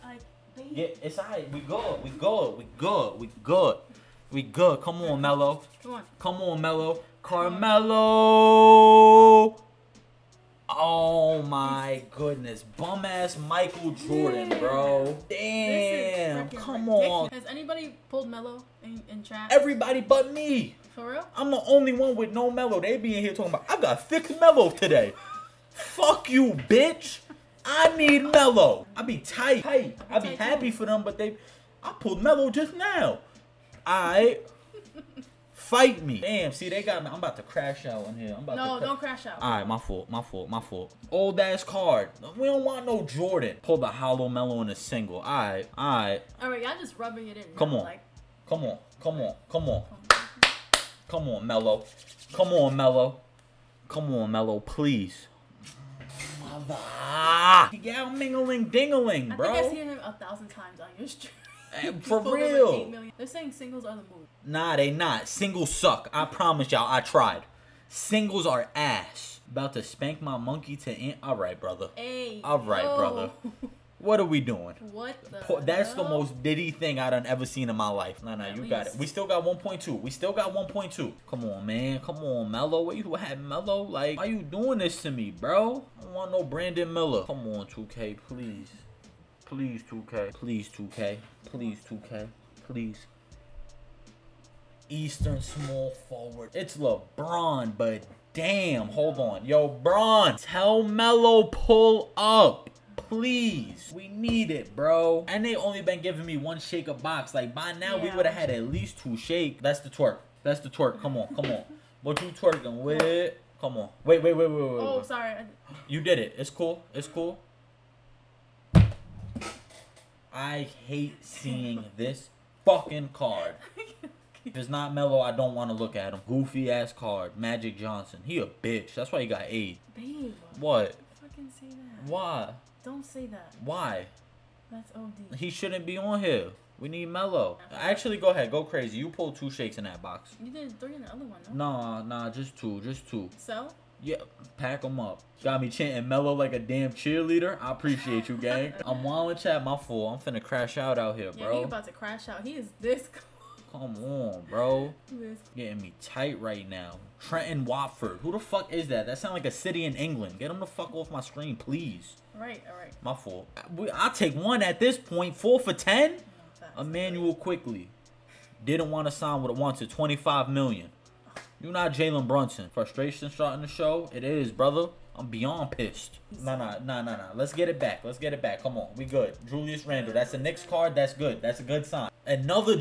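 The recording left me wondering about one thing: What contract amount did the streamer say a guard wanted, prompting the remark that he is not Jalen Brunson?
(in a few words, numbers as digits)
25 million.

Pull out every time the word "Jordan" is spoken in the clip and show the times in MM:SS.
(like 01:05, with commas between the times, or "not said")
00:13, 00:43.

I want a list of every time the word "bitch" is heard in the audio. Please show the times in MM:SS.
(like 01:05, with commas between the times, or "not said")
00:26, 02:08.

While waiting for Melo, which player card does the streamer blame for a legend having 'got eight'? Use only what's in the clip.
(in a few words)
Magic Johnson.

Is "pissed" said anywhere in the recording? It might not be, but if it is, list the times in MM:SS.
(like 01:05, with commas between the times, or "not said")
02:55.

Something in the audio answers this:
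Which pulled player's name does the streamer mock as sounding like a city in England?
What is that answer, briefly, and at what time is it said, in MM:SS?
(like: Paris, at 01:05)
Trendon Watford, at 02:37.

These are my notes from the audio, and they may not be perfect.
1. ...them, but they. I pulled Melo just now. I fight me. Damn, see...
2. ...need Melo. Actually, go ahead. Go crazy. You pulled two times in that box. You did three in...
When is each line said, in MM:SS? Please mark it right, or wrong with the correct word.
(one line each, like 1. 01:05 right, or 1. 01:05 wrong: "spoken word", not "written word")
1. 00:30 right
2. 02:16 wrong: "shakes", not "times".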